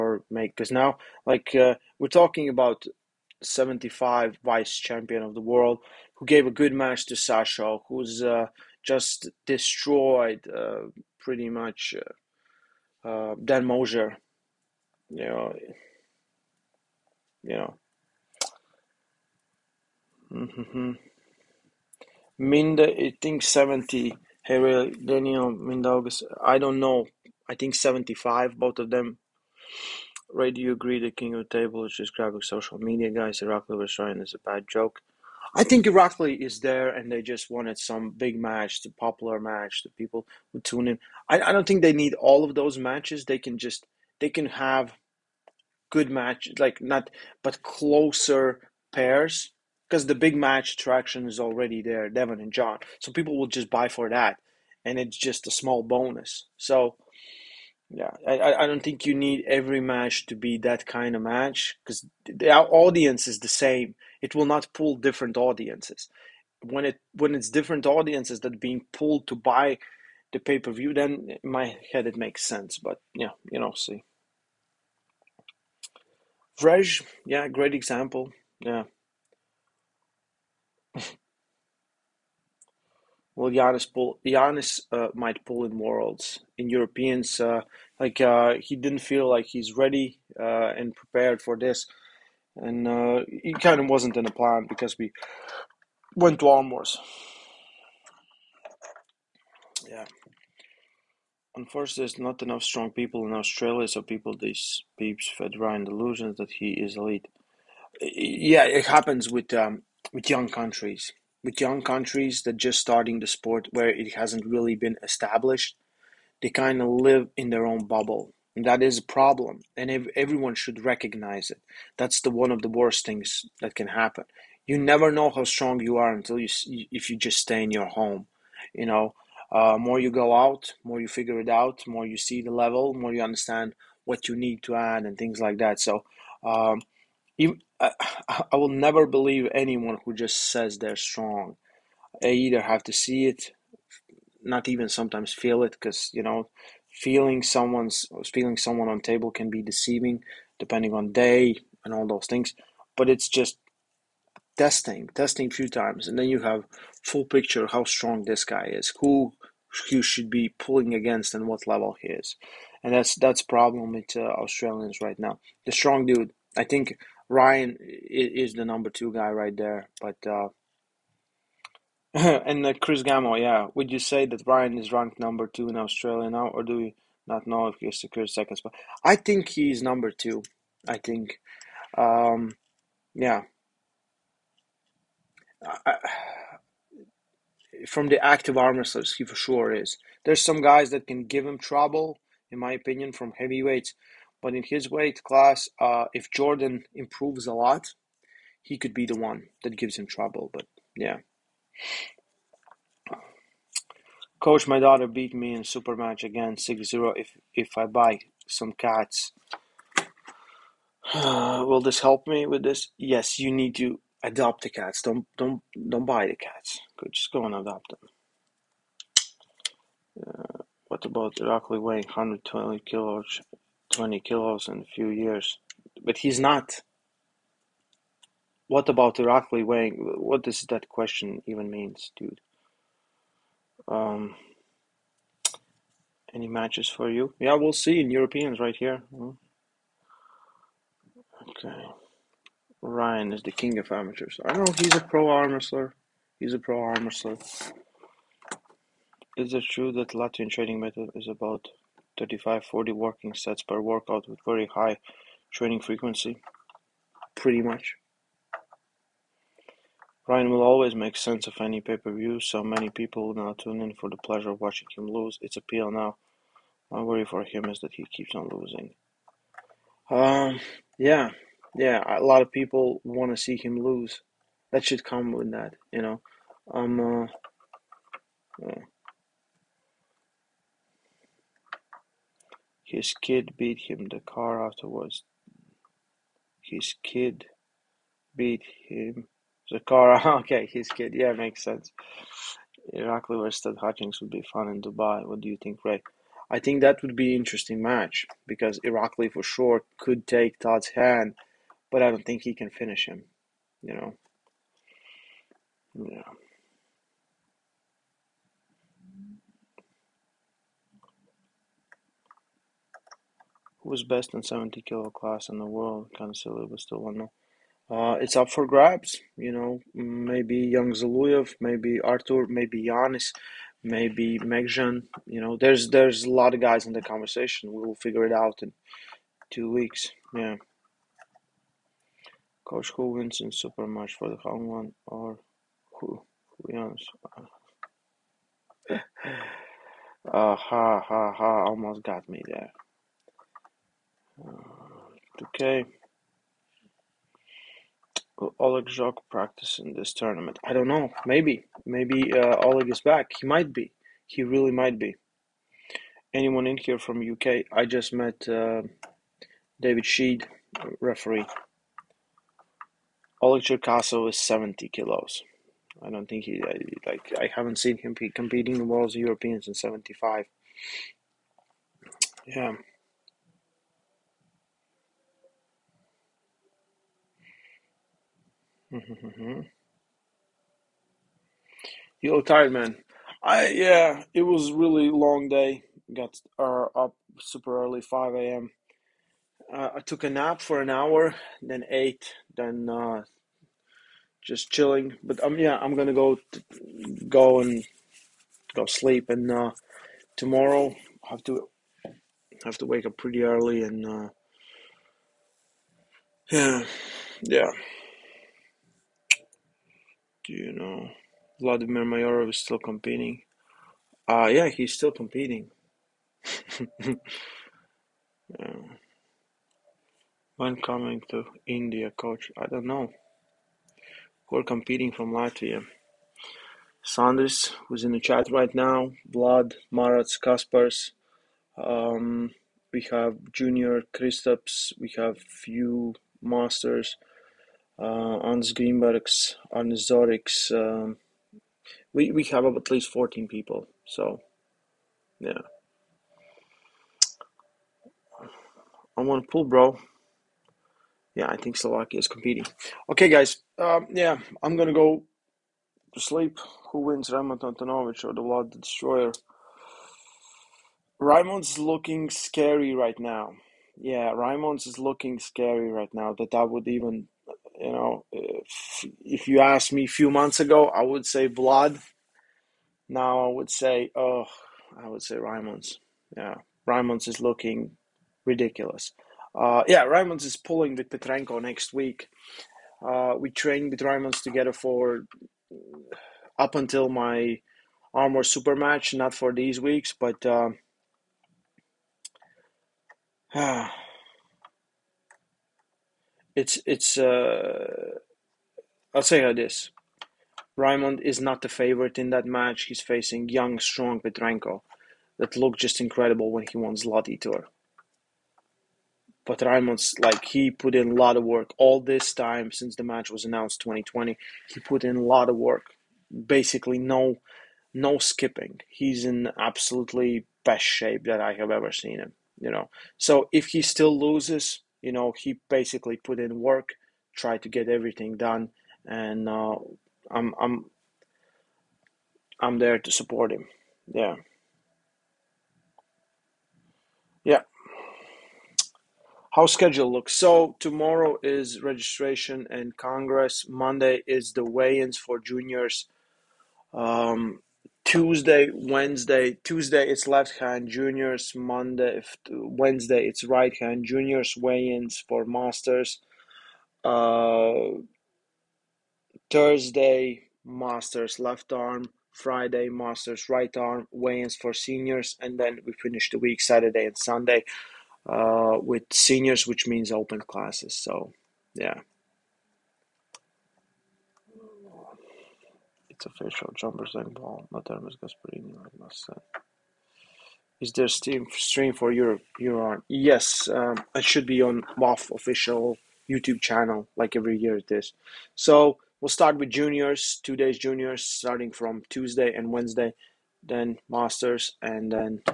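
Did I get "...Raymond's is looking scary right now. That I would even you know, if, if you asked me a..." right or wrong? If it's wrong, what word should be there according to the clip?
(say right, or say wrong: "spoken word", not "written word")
right.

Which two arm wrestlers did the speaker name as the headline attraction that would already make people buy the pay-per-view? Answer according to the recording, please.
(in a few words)
Devon and John.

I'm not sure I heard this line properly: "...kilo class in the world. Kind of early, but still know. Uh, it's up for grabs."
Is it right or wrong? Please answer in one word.
wrong.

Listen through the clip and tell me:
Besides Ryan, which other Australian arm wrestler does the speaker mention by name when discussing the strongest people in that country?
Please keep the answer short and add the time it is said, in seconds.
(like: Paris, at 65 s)
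Chris Gamble, at 172 s.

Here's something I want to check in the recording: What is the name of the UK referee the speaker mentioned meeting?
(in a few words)
David Sheed.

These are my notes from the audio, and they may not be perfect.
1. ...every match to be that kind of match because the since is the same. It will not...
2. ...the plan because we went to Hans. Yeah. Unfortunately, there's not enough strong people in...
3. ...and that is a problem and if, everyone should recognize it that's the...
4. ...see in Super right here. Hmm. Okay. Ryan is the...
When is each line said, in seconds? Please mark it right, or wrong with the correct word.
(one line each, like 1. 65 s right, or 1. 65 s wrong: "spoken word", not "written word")
1. 59 s wrong: "audience", not "since"
2. 94 s wrong: "Almors", not "Hans"
3. 118 s right
4. 237 s wrong: "Europeans", not "Super".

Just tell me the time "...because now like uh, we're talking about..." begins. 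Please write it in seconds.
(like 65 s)
0 s.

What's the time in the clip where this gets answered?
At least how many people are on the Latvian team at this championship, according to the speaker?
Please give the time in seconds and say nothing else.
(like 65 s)
443 s.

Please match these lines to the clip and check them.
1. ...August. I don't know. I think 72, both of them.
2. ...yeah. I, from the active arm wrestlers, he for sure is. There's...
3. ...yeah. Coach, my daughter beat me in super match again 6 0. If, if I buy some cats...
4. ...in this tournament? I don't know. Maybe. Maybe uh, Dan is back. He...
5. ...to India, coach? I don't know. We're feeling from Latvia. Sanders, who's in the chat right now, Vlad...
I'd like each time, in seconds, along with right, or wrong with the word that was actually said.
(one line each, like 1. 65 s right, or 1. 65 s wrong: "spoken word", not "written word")
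1. 25 s wrong: "75", not "72"
2. 183 s right
3. 200 s right
4. 349 s wrong: "Oleg", not "Dan"
5. 421 s wrong: "competing", not "feeling".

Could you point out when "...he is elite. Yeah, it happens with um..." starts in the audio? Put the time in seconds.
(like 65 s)
106 s.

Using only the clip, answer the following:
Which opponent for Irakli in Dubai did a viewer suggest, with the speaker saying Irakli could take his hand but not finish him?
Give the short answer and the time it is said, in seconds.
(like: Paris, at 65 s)
Todd Hutchings, at 293 s.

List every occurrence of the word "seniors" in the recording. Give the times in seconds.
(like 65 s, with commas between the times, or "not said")
564 s, 569 s.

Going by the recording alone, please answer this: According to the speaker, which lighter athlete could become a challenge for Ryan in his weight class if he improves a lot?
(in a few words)
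Jordan.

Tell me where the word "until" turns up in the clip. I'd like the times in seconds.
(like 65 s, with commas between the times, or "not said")
126 s, 486 s.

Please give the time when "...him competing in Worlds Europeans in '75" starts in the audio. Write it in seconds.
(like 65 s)
367 s.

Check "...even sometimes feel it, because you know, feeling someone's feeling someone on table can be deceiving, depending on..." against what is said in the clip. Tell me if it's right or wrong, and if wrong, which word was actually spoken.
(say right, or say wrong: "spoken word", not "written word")
right.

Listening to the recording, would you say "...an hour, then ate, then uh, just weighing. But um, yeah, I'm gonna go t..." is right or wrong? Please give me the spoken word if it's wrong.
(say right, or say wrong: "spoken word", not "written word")
wrong: "chilling", not "weighing".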